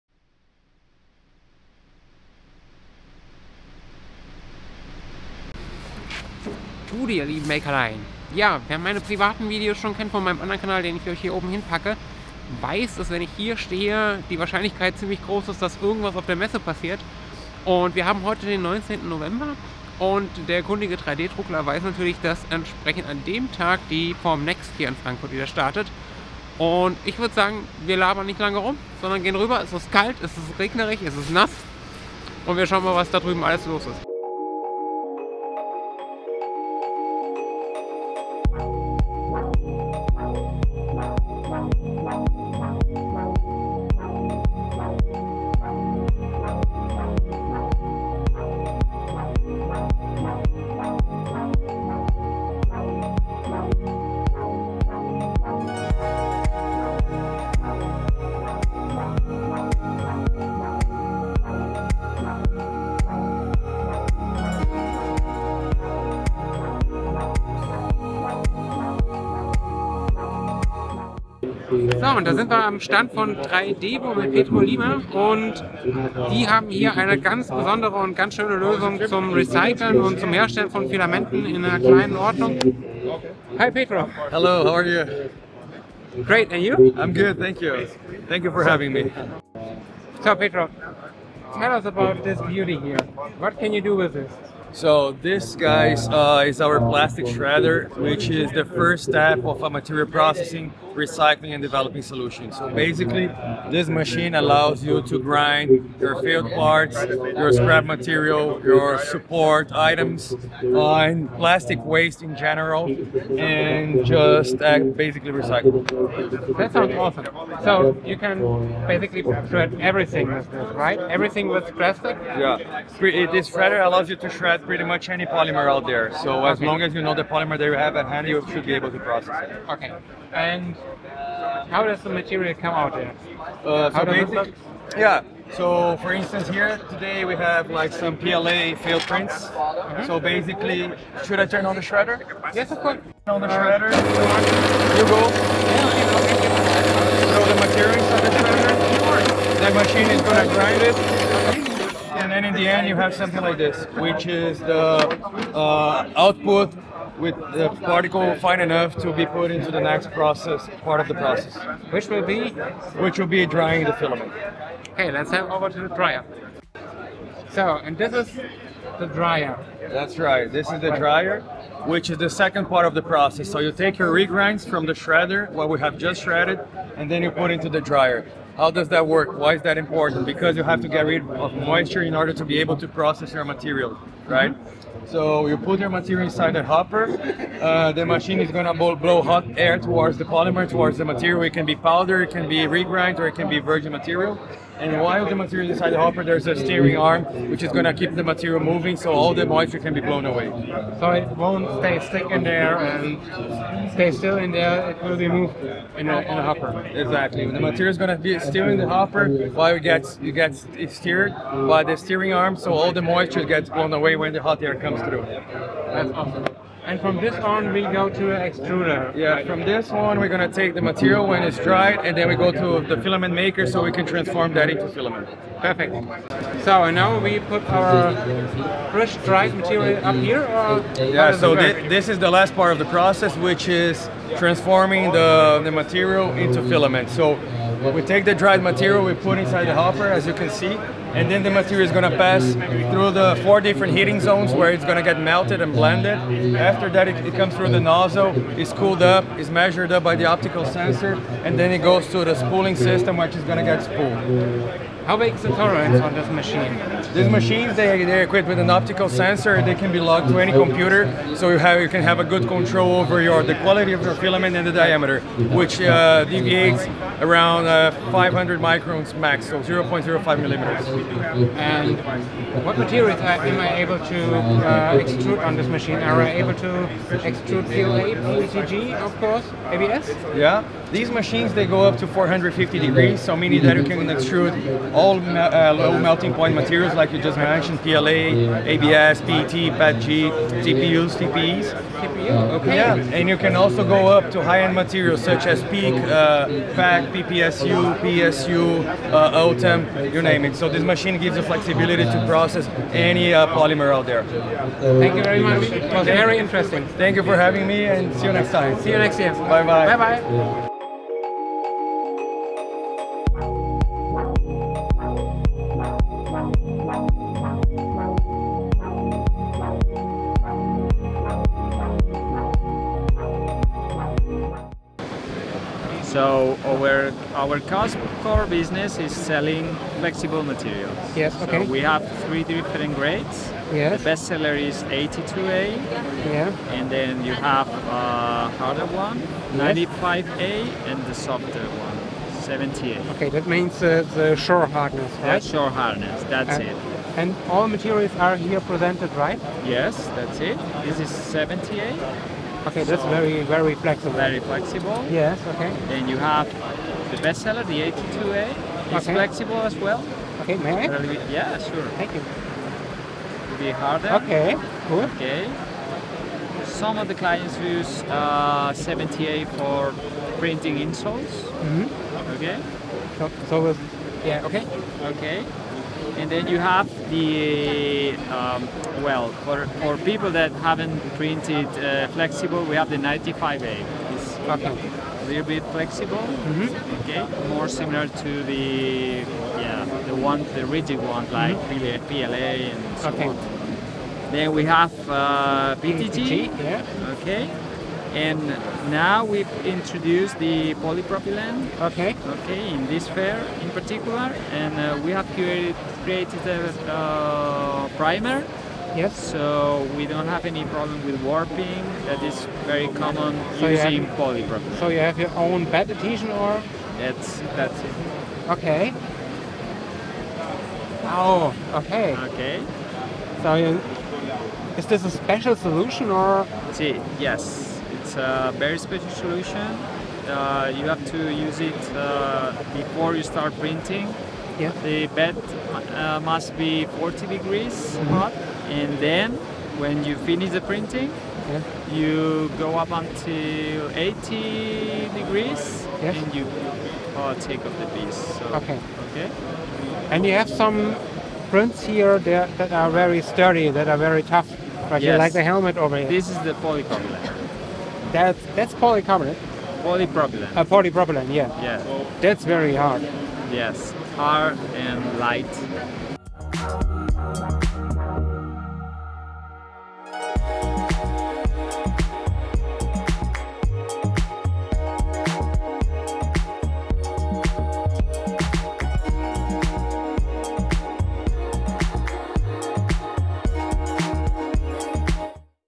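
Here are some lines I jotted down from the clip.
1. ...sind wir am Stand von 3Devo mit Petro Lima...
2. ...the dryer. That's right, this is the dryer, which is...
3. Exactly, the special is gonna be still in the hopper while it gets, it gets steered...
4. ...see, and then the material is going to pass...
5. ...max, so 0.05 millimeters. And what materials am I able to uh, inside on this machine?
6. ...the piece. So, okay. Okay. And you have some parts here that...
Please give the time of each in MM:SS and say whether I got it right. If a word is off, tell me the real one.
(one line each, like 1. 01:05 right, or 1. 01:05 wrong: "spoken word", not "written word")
1. 01:12 right
2. 02:48 right
3. 03:26 wrong: "material", not "special"
4. 04:00 right
5. 04:29 wrong: "extrude", not "inside"
6. 07:27 wrong: "prints", not "parts".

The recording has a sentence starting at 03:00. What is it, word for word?
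Because you have to get rid of moisture in order to be able to process your material.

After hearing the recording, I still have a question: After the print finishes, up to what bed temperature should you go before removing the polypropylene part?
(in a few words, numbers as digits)
80.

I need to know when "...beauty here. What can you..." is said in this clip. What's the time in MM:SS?
01:32.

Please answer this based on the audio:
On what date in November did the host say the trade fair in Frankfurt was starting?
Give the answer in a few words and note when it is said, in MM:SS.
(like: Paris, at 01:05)
19 November, at 00:18.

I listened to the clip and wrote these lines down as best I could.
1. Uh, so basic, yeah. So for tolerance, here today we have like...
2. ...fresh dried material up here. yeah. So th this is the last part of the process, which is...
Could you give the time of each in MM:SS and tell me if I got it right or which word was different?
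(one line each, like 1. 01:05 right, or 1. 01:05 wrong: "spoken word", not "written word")
1. 02:13 wrong: "instance", not "tolerance"
2. 03:48 right.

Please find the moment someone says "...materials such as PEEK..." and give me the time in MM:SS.
04:54.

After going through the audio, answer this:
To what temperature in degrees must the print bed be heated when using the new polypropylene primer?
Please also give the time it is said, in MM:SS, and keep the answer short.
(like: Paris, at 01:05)
40, at 07:16.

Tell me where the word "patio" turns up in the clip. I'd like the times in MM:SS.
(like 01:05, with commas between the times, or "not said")
not said.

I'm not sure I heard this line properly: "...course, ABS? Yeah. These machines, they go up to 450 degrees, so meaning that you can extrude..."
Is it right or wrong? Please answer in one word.
right.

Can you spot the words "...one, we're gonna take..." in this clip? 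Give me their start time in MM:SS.
03:39.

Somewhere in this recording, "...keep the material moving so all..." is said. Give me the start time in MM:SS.
03:17.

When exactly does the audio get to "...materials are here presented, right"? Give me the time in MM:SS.
05:47.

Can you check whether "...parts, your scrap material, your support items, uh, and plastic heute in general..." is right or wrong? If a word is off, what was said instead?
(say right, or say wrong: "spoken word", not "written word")
wrong: "waste", not "heute".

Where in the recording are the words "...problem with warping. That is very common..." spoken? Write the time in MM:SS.
06:50.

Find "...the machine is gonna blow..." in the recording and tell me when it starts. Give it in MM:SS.
03:07.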